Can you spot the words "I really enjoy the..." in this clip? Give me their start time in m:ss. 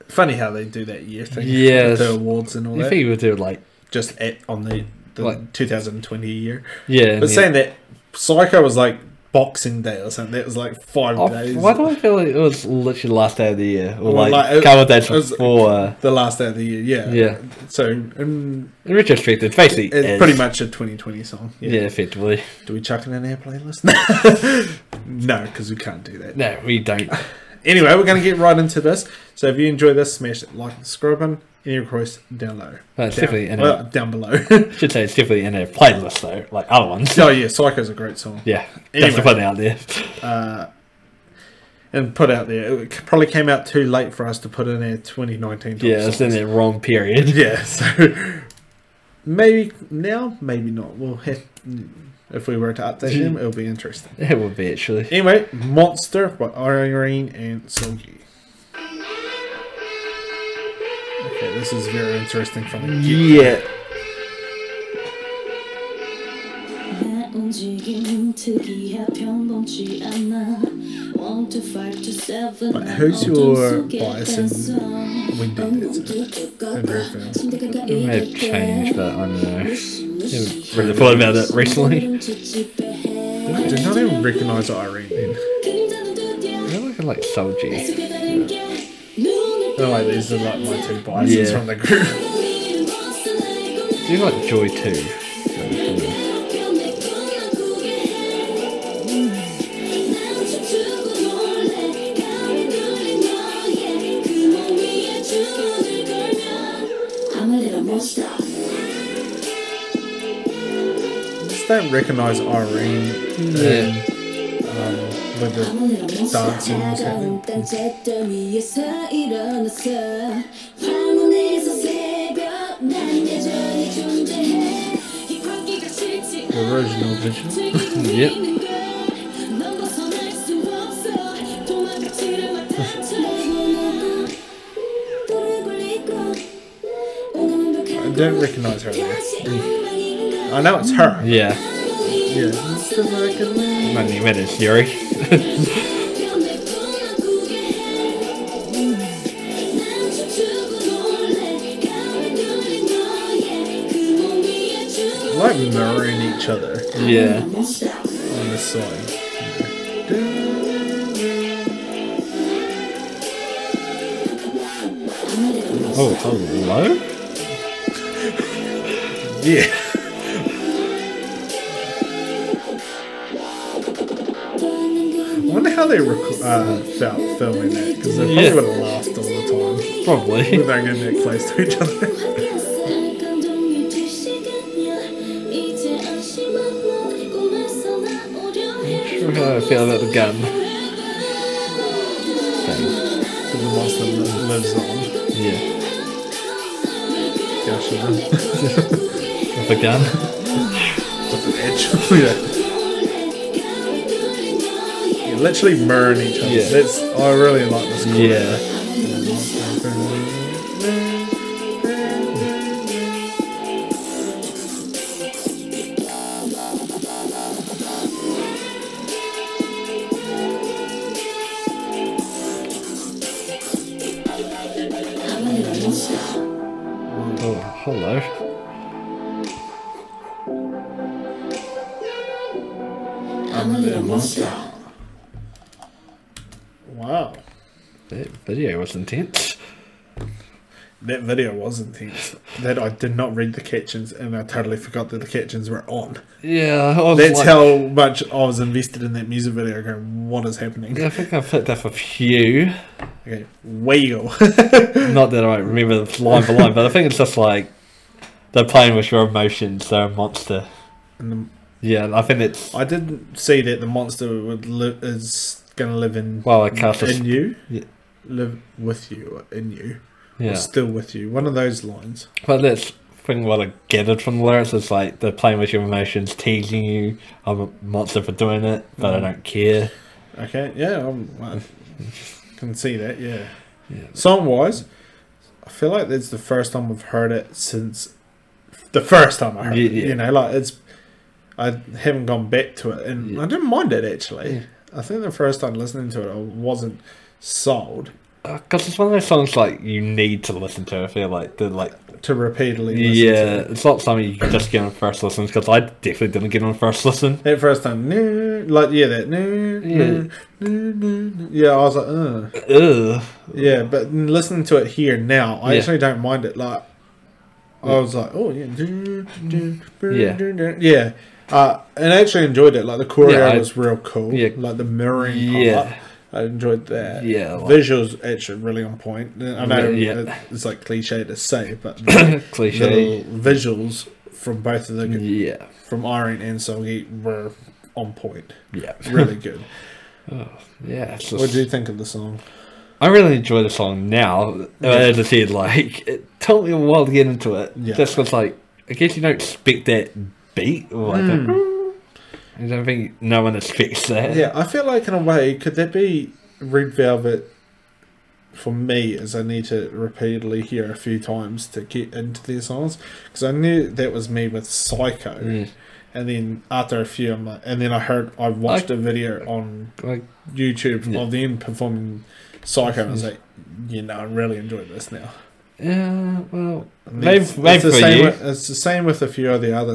5:42.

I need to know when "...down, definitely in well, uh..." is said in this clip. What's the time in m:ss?
0:33.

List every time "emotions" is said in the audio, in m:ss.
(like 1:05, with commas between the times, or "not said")
4:19, 4:35.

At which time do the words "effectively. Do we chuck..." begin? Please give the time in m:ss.
0:21.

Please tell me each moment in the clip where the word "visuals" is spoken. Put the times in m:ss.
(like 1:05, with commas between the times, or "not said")
5:27, 5:33.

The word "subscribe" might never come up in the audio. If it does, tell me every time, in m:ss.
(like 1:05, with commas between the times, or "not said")
0:30.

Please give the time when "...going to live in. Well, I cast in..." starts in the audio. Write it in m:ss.
4:25.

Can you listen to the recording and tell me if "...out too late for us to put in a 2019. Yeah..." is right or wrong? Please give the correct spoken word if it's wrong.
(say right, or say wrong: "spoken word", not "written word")
right.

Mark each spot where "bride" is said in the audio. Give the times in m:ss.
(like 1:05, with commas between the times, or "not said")
not said.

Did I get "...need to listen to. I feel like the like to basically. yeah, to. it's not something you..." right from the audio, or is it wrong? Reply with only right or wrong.
wrong.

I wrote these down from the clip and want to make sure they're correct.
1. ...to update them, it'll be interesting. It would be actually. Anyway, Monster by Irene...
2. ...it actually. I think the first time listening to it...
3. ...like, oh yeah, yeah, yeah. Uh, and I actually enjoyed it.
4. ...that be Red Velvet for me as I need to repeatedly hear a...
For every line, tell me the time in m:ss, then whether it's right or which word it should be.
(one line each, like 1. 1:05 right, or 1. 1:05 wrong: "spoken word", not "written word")
1. 0:52 right
2. 4:53 right
3. 5:18 right
4. 5:55 right.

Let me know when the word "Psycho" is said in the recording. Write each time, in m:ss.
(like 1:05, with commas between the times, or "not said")
0:08, 0:37, 6:04, 6:12.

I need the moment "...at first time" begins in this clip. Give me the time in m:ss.
5:07.